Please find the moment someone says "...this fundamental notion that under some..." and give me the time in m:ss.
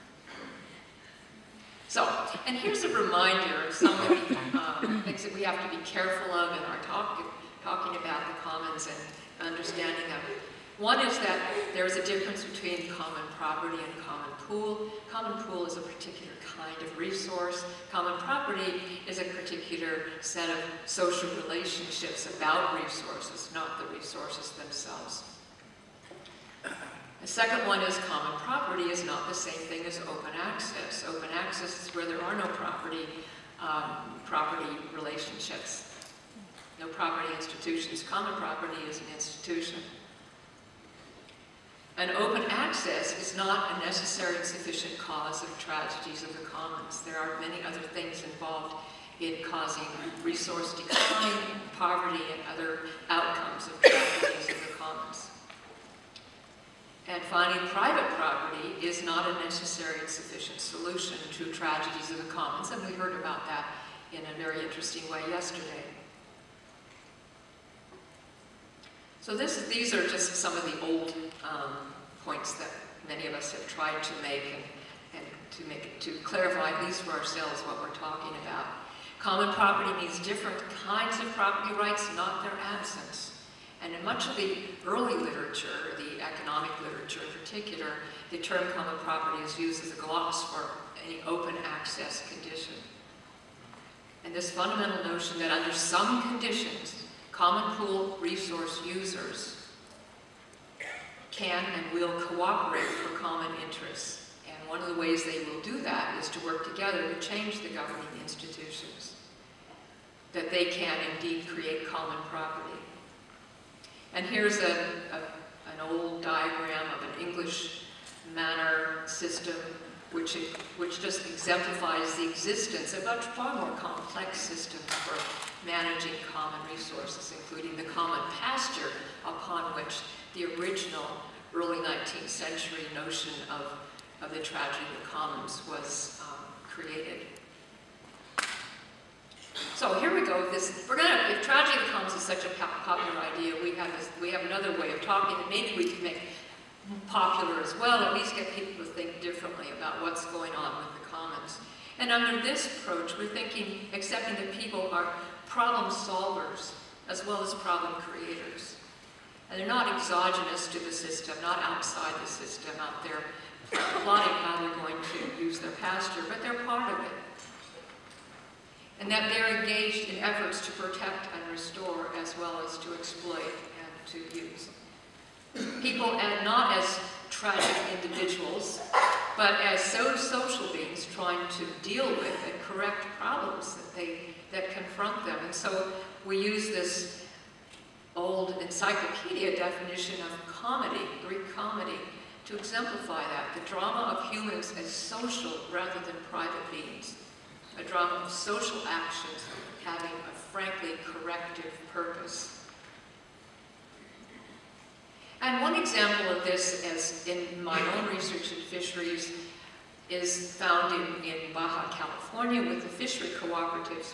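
1:34.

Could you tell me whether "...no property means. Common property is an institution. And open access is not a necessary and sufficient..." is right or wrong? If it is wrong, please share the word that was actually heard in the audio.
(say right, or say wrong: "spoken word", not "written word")
wrong: "institutions", not "means".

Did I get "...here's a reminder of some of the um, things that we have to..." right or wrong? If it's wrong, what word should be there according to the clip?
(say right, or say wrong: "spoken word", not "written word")
right.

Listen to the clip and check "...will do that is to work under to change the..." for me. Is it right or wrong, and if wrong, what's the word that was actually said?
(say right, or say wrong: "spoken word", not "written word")
wrong: "together", not "under".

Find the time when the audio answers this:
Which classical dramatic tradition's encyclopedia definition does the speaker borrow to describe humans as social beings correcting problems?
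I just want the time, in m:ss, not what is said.
3:11.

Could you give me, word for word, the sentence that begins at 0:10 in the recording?
One is that there's a difference between common property and common pool.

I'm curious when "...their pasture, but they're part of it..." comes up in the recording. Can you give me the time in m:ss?
2:45.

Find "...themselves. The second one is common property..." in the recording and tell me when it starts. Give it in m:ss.
0:24.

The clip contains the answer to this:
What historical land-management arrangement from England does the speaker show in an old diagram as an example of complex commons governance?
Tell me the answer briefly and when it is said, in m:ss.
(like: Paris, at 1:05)
English manor system, at 1:57.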